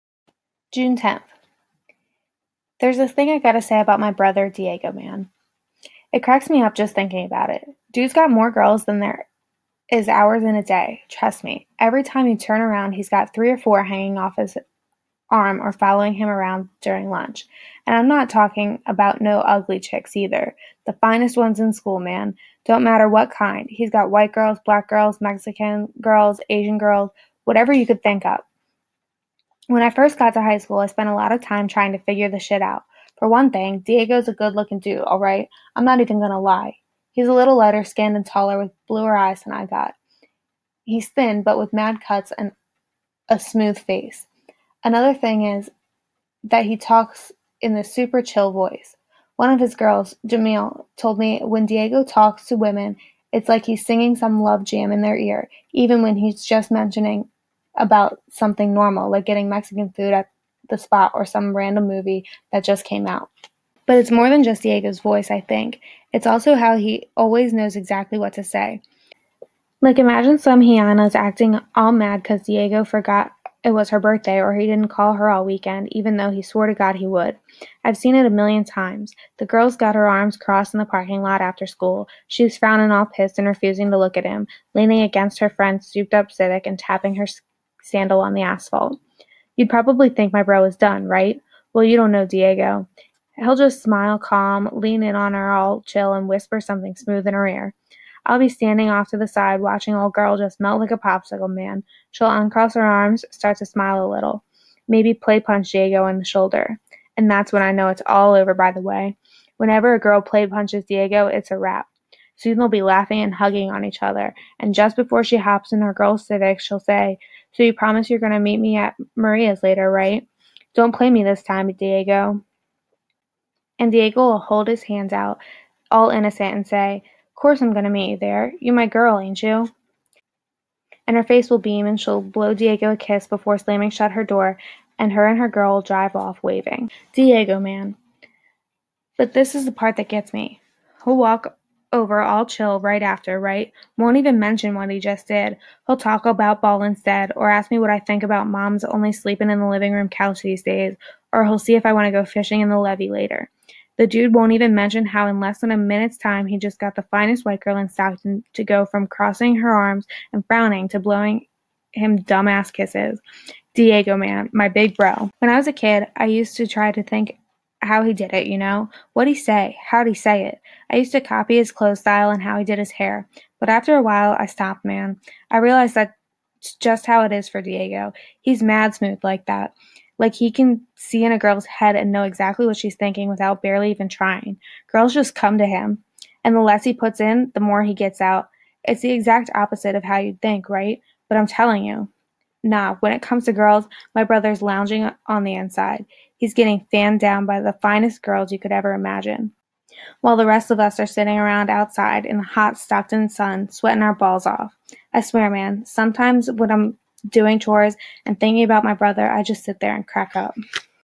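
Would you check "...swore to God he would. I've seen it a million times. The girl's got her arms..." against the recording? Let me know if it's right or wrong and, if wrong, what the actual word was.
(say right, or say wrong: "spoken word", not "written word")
right.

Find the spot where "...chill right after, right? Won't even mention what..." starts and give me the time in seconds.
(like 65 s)
142 s.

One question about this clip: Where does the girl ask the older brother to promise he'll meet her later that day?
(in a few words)
Maria's.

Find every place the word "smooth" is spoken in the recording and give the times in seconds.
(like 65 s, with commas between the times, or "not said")
43 s, 96 s, 178 s.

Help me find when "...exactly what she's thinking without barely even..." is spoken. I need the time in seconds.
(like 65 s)
182 s.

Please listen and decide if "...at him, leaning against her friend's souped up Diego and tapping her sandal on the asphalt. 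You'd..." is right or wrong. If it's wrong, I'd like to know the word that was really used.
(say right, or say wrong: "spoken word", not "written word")
wrong: "Civic", not "Diego".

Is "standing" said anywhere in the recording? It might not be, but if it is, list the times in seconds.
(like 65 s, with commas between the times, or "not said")
98 s.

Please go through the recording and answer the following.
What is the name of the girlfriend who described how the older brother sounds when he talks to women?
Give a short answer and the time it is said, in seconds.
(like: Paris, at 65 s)
Jamil, at 50 s.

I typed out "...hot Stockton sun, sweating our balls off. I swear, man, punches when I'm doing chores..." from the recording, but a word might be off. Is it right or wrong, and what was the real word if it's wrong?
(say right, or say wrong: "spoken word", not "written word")
wrong: "sometimes", not "punches".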